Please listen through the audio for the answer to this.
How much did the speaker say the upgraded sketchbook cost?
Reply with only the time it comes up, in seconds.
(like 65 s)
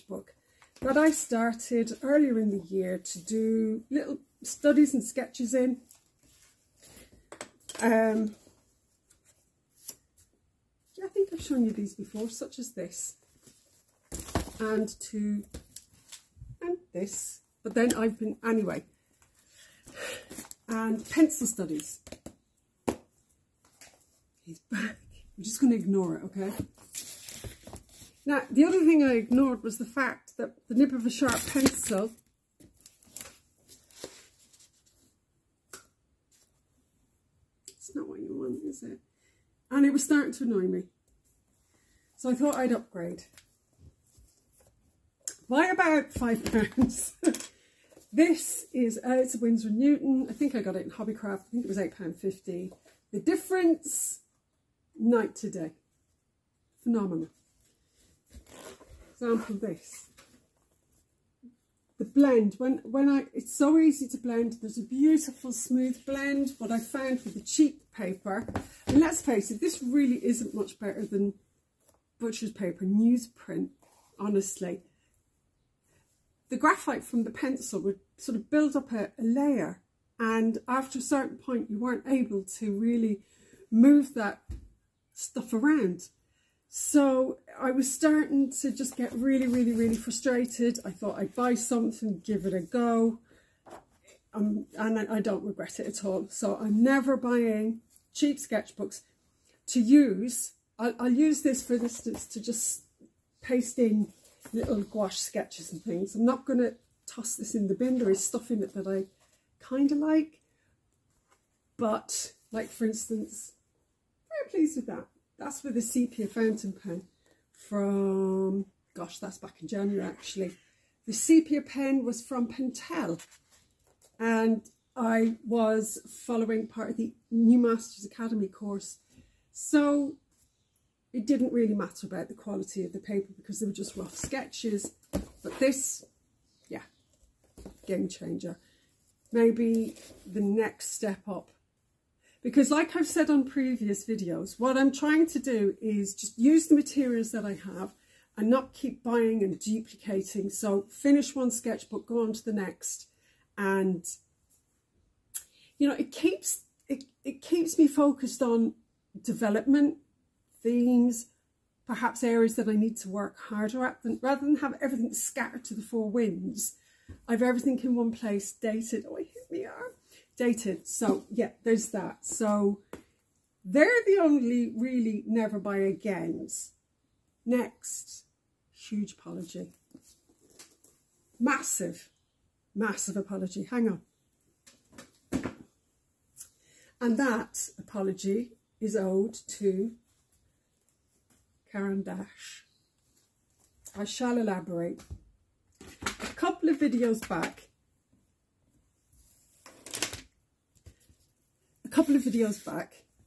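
51 s.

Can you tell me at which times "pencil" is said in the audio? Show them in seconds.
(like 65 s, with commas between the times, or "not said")
21 s, 31 s, 77 s.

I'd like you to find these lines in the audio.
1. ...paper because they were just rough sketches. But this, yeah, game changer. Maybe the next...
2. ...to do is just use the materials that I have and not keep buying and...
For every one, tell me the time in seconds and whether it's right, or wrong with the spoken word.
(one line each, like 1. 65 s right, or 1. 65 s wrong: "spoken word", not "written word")
1. 132 s right
2. 145 s right.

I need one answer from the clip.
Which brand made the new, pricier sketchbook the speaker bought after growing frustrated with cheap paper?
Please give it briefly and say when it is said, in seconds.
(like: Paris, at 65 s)
Winsor Newton, at 49 s.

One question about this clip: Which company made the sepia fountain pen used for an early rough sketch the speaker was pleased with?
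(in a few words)
Pentel.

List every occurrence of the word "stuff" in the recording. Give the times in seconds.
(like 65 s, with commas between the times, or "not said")
85 s, 108 s.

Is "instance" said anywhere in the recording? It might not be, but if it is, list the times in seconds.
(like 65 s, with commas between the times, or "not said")
101 s, 112 s.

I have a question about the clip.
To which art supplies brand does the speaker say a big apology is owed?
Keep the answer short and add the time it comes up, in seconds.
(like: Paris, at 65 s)
Caran D'Ache, at 191 s.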